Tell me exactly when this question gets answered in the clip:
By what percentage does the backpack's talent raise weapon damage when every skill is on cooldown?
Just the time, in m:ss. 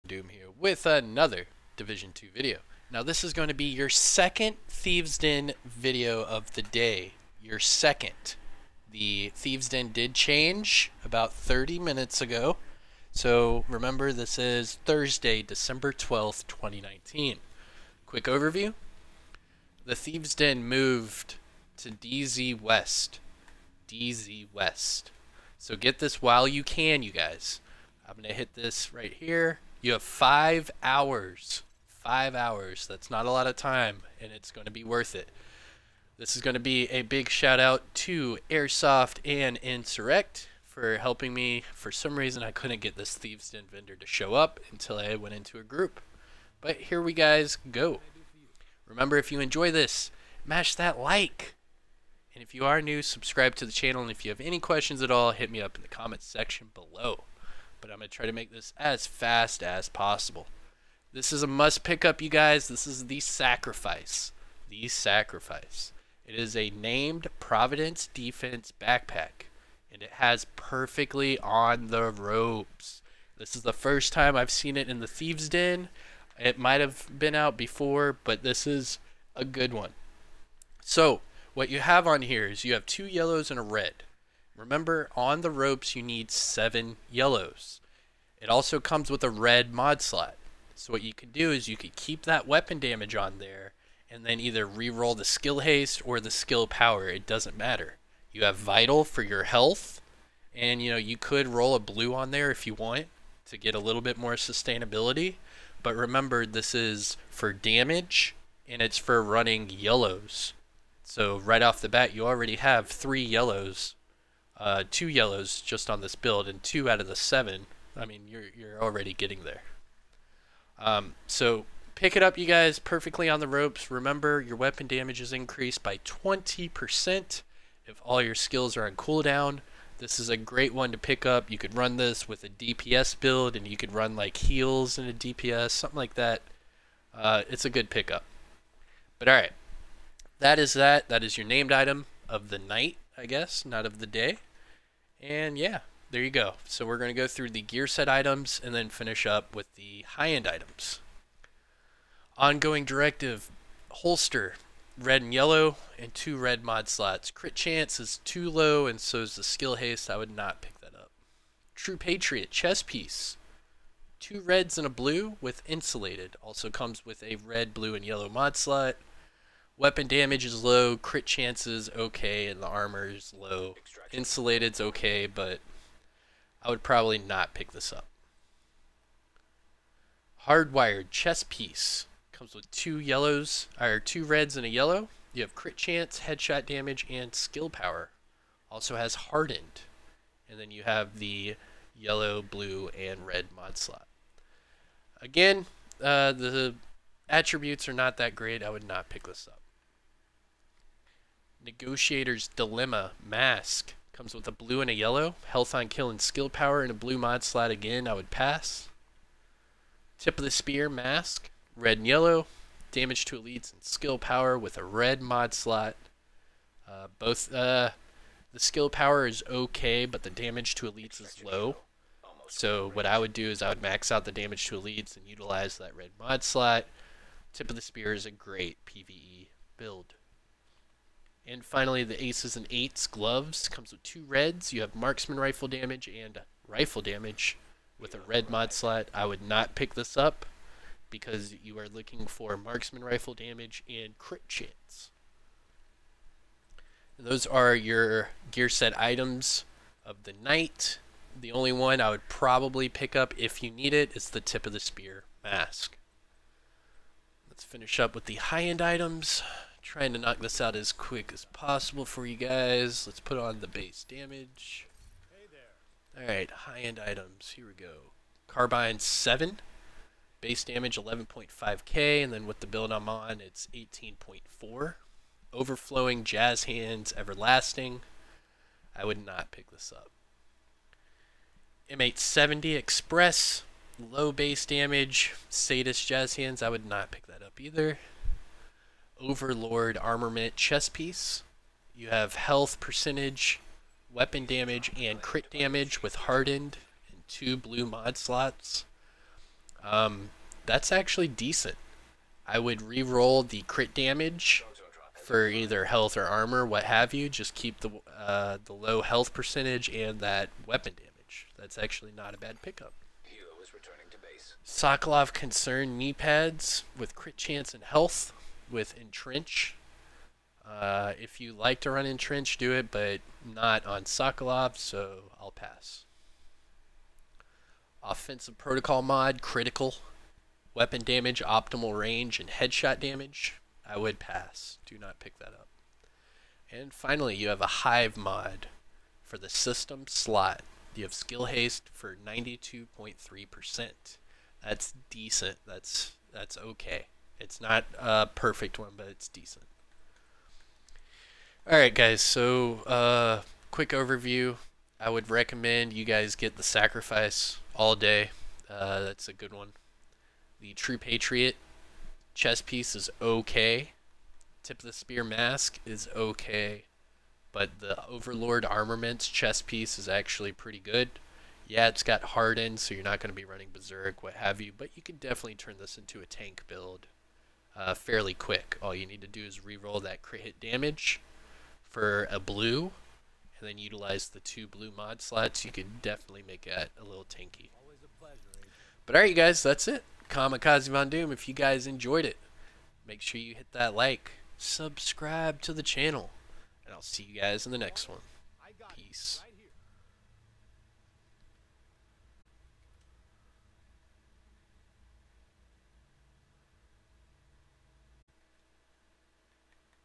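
2:05.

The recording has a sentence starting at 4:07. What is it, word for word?
And those are your gear set items of the night.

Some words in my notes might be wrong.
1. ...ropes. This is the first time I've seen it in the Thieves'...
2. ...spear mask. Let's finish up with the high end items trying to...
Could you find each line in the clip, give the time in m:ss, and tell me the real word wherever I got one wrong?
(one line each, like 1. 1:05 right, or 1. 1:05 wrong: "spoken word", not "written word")
1. 1:12 right
2. 4:14 right.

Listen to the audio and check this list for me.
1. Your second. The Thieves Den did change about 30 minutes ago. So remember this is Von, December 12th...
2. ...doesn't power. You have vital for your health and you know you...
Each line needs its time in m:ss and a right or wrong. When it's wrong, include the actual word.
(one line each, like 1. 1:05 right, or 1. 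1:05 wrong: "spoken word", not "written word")
1. 0:07 wrong: "Thursday", not "Von"
2. 1:37 wrong: "matter", not "power".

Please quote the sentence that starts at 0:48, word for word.
Remember, if you enjoy this, mash that like.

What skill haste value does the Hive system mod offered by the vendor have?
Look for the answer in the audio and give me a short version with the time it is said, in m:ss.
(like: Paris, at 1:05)
92.3%, at 5:42.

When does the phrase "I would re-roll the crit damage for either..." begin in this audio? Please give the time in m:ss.
5:02.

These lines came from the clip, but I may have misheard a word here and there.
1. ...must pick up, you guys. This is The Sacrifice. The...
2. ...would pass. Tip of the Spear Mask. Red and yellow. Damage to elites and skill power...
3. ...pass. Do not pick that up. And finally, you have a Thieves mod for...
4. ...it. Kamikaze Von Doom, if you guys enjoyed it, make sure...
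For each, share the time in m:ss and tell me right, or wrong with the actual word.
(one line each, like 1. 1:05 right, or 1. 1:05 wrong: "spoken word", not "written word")
1. 1:01 right
2. 3:28 right
3. 5:34 wrong: "Hive", not "Thieves"
4. 6:29 right.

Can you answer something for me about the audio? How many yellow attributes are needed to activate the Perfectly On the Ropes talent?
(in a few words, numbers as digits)
7.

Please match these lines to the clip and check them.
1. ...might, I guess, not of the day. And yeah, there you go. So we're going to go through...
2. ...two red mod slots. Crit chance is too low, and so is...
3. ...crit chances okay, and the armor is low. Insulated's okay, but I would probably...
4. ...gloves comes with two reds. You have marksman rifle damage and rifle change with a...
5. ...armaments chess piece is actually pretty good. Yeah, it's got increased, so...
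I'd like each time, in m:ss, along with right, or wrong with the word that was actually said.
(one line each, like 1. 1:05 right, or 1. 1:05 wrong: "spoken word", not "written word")
1. 2:22 wrong: "night", not "might"
2. 2:36 right
3. 2:50 right
4. 3:53 wrong: "damage", not "change"
5. 6:08 wrong: "hardened", not "increased".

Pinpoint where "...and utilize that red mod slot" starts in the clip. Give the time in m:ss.
3:45.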